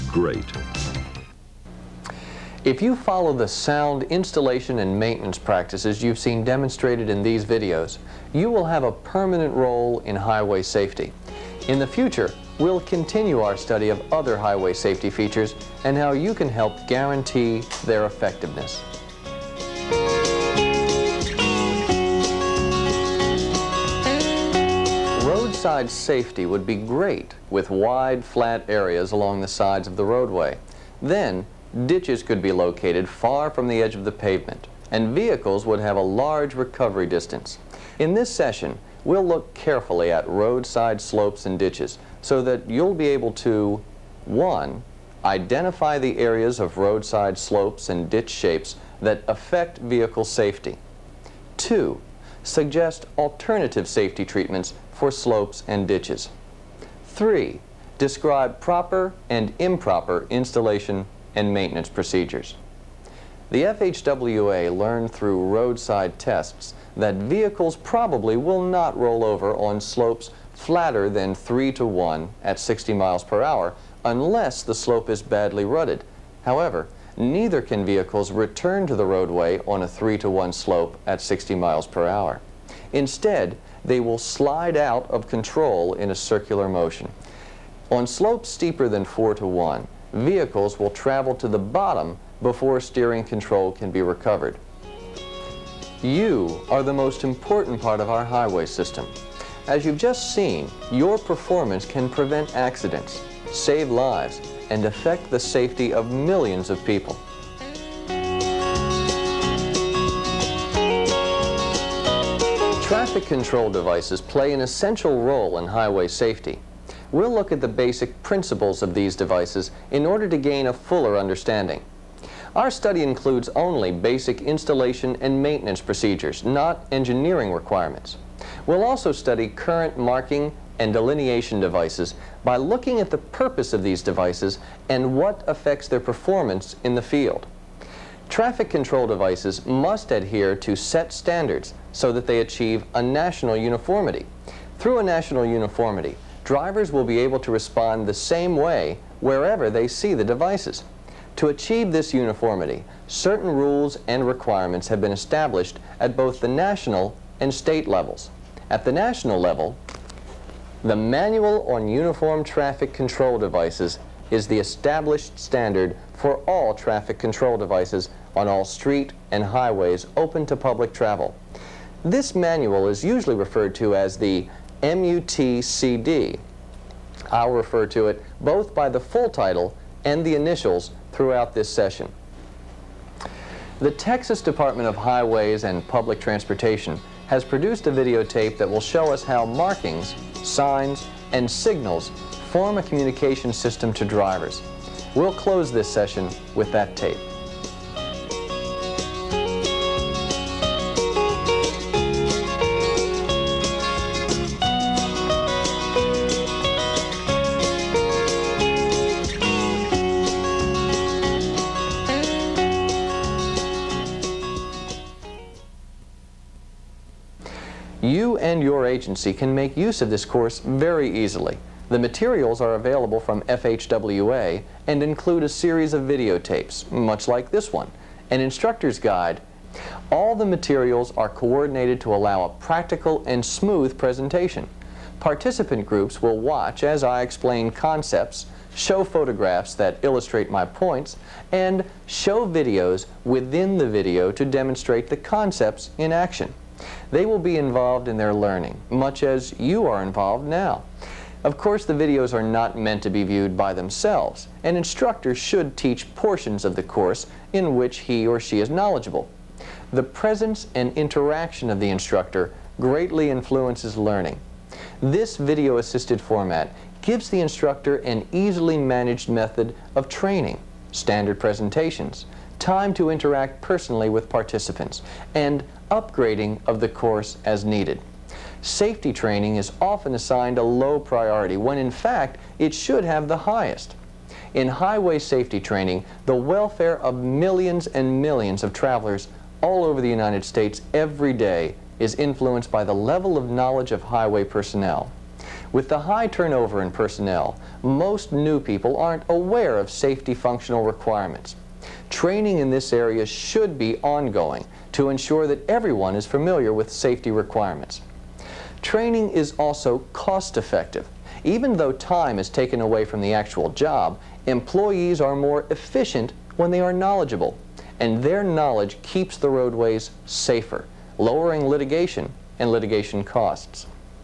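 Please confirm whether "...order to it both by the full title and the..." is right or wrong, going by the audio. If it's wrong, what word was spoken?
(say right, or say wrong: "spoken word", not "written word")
wrong: "refer", not "order".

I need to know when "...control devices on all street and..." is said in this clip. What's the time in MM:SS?
02:47.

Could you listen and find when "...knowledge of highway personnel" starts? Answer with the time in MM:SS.
04:53.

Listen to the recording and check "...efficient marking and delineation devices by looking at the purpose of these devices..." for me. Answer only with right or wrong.
wrong.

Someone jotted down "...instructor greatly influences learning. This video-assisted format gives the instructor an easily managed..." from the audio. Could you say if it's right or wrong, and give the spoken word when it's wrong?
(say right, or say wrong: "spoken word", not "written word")
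right.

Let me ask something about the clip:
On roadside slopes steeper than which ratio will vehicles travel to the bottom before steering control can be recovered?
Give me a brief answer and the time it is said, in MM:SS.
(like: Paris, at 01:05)
4 to 1, at 01:29.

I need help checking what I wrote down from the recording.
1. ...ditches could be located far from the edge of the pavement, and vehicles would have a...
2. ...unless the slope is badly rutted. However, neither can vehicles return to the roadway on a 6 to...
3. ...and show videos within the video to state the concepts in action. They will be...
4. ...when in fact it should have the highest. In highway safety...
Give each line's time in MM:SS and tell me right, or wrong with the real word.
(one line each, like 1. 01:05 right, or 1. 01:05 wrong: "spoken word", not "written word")
1. 00:31 right
2. 01:14 wrong: "3", not "6"
3. 04:01 wrong: "demonstrate", not "state"
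4. 04:41 right.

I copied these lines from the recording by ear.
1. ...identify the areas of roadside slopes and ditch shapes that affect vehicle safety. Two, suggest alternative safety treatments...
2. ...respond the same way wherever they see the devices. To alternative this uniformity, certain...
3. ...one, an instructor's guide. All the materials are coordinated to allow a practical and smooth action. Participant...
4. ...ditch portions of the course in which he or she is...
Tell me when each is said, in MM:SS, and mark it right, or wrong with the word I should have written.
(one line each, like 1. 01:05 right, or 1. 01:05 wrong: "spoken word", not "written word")
1. 00:45 right
2. 02:27 wrong: "achieve", not "alternative"
3. 03:47 wrong: "presentation", not "action"
4. 04:15 wrong: "teach", not "ditch".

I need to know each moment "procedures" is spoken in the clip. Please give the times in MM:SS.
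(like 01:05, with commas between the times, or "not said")
01:01, 02:05.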